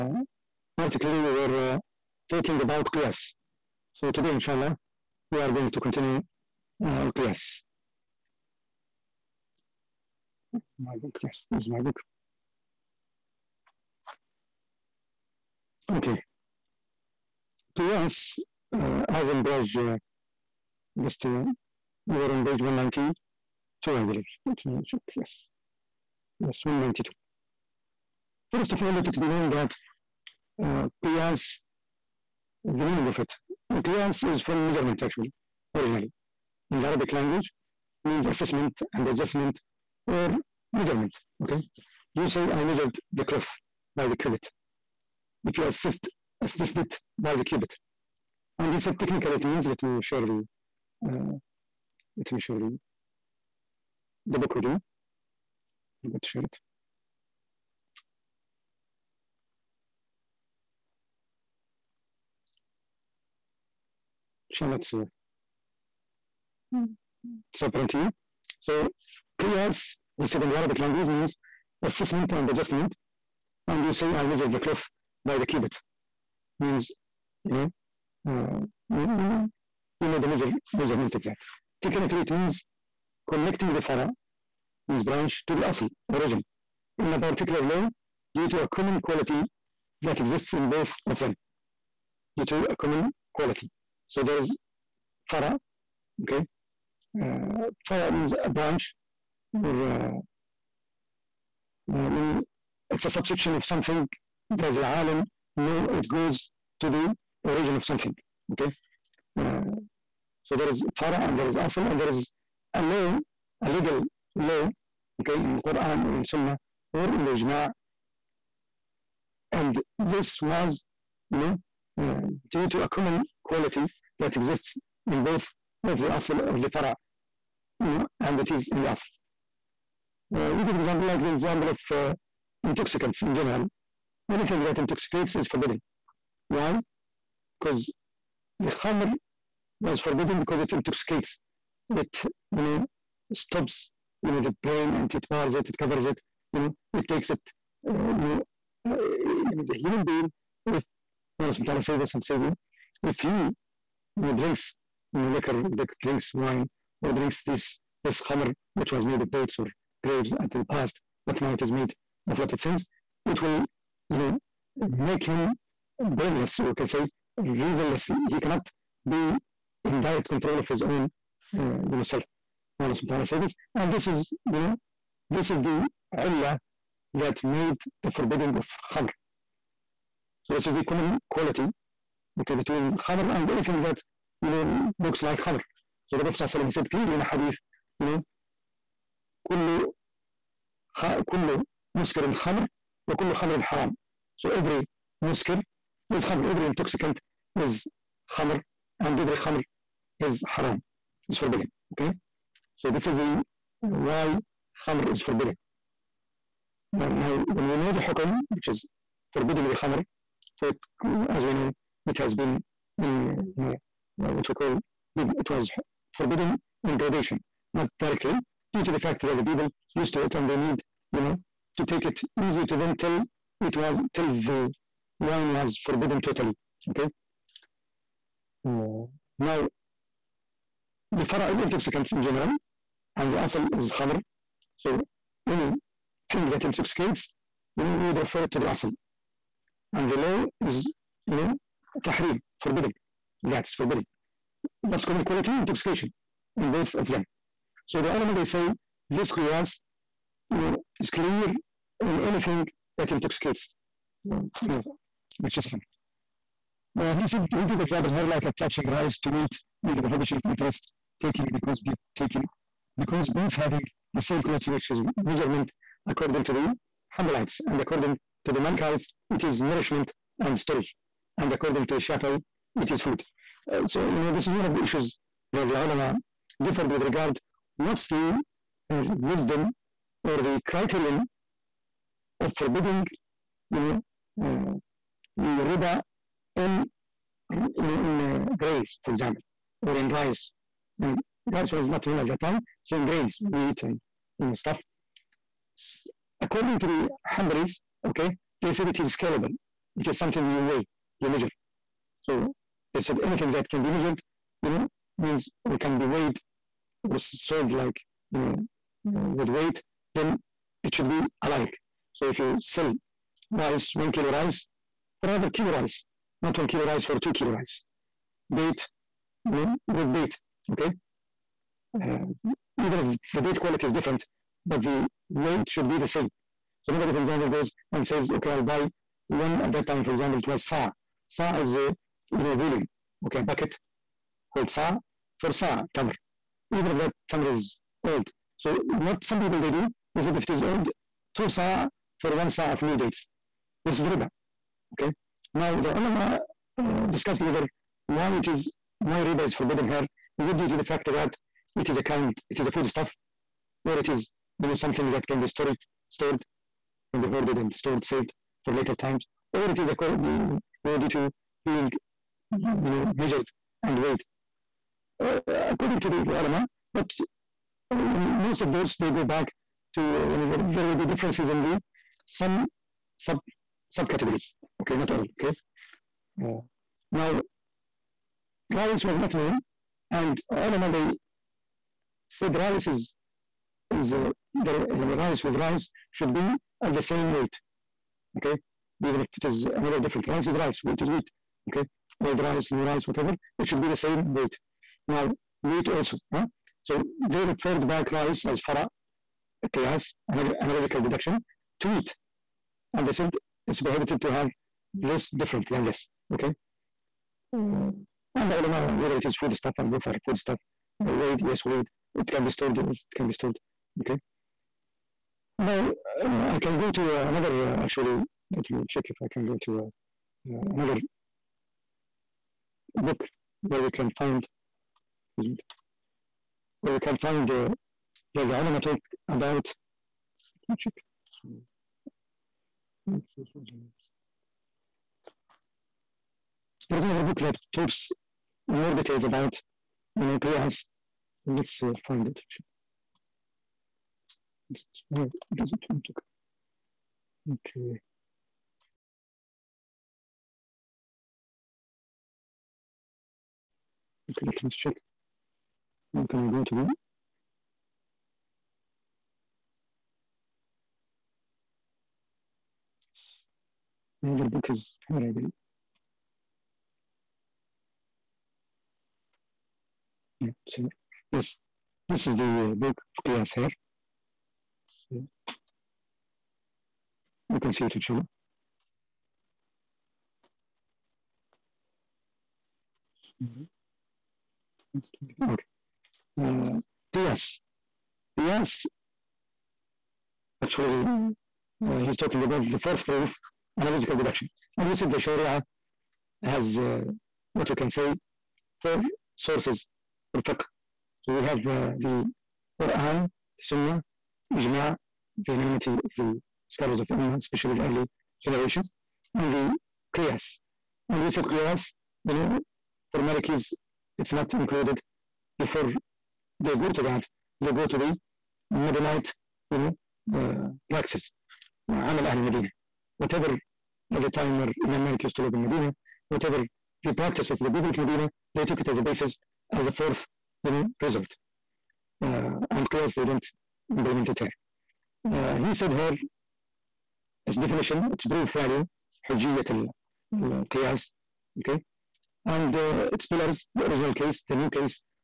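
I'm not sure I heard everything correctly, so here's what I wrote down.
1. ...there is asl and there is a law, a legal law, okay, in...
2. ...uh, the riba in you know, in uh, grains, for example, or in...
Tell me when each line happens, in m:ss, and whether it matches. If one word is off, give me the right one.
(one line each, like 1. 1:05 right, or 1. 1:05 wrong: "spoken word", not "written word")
1. 1:51 right
2. 4:44 right.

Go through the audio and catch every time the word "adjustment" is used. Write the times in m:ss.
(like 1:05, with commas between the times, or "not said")
0:39, 1:12.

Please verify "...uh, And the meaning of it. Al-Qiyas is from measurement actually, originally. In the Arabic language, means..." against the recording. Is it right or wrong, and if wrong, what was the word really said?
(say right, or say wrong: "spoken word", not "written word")
wrong: "Qiyas", not "And".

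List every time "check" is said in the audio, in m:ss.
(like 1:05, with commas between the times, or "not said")
0:24, 6:58, 7:34.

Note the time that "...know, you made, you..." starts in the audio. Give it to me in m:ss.
1:18.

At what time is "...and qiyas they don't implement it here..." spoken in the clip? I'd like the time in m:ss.
8:52.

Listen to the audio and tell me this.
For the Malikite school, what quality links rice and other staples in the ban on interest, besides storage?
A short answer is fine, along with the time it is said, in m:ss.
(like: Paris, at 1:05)
nourishment, at 4:29.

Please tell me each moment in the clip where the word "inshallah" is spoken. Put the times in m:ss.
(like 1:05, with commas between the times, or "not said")
0:04, 1:04, 7:57.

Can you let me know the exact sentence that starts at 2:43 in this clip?
It will, you know, make him brainless, or you can say reasonless.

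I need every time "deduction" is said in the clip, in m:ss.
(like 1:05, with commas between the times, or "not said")
6:41, 8:14.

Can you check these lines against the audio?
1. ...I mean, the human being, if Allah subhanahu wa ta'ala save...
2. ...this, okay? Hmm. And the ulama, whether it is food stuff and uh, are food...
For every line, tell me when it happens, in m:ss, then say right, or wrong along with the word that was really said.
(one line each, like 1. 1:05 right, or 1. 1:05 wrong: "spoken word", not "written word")
1. 2:28 right
2. 6:45 right.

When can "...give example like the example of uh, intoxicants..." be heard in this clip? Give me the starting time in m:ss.
2:10.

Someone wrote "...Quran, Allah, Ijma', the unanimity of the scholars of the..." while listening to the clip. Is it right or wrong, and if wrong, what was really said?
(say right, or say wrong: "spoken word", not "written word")
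wrong: "Sunnah", not "Allah".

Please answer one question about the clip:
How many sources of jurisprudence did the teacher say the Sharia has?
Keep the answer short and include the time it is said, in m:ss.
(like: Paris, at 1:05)
4, at 8:18.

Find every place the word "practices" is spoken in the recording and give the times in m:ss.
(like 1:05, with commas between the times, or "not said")
8:40, 8:47.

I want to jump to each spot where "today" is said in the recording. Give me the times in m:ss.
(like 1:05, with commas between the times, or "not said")
0:04.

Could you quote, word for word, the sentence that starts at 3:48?
Uh, now, the fara is intoxicants in general, and the asal is khamr.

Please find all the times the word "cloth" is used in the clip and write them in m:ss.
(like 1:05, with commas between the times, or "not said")
0:43, 1:14.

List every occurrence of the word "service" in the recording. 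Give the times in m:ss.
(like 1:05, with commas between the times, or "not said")
not said.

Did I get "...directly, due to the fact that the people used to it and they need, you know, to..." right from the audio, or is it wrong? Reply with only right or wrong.
right.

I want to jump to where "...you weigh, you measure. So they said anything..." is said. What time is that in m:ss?
5:00.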